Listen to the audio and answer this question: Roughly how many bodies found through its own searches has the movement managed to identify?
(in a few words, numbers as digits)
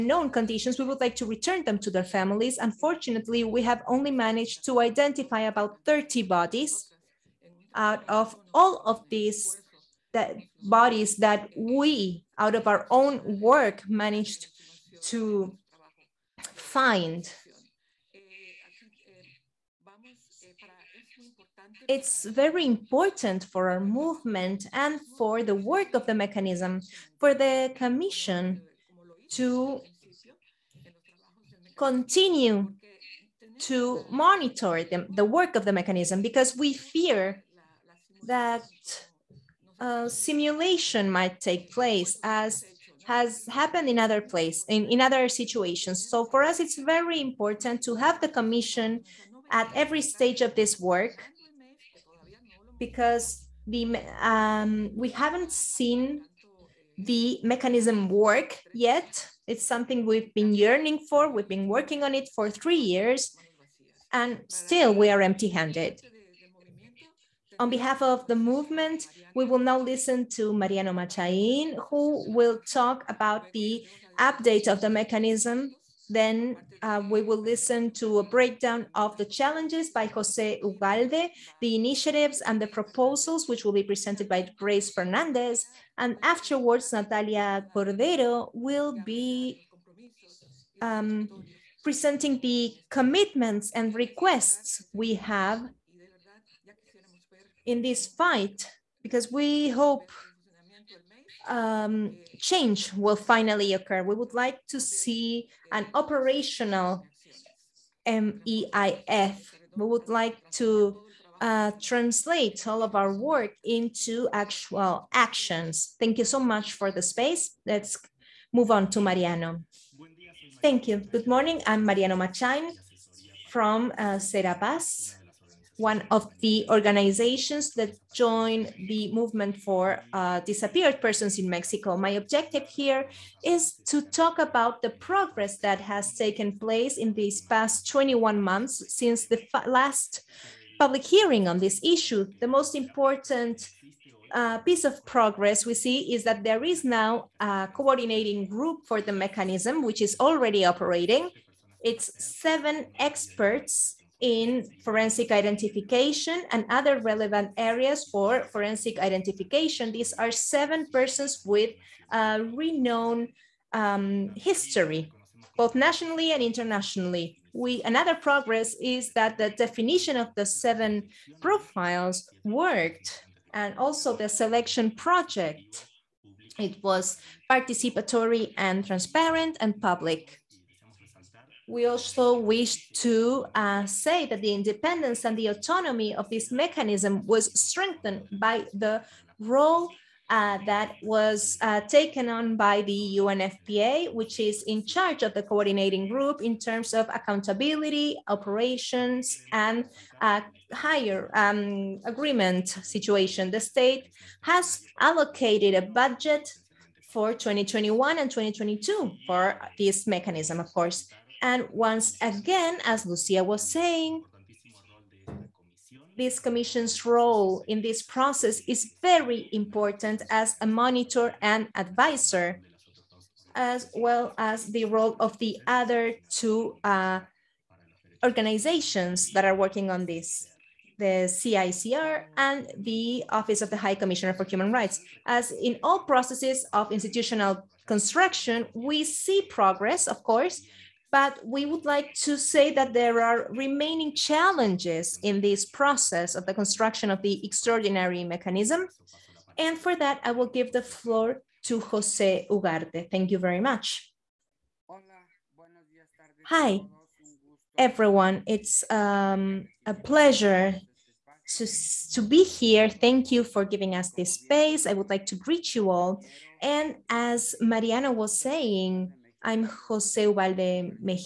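30.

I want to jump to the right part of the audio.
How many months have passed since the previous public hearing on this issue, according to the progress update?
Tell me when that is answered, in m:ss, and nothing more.
2:17.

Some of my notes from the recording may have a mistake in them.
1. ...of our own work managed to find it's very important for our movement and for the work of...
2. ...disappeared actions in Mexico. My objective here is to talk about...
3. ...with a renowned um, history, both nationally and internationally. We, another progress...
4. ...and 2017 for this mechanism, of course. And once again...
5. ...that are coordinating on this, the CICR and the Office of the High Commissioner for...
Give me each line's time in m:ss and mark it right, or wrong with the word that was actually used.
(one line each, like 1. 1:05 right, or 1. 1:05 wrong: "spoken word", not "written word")
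1. 0:12 right
2. 2:10 wrong: "persons", not "actions"
3. 2:41 right
4. 3:28 wrong: "2022", not "2017"
5. 3:49 wrong: "working", not "coordinating".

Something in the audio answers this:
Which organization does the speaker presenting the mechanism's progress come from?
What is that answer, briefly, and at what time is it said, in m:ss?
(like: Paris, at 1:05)
Serapaz, at 2:04.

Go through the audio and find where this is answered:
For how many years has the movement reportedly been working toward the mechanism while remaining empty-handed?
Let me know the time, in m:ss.
1:02.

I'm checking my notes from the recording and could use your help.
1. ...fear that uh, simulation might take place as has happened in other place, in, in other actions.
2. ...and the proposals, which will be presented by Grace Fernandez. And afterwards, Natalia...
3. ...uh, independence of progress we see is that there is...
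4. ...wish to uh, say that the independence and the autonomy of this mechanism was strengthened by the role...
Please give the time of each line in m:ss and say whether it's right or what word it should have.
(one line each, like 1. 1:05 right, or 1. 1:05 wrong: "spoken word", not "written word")
1. 0:36 wrong: "situations", not "actions"
2. 1:22 right
3. 2:24 wrong: "piece", not "independence"
4. 3:02 right.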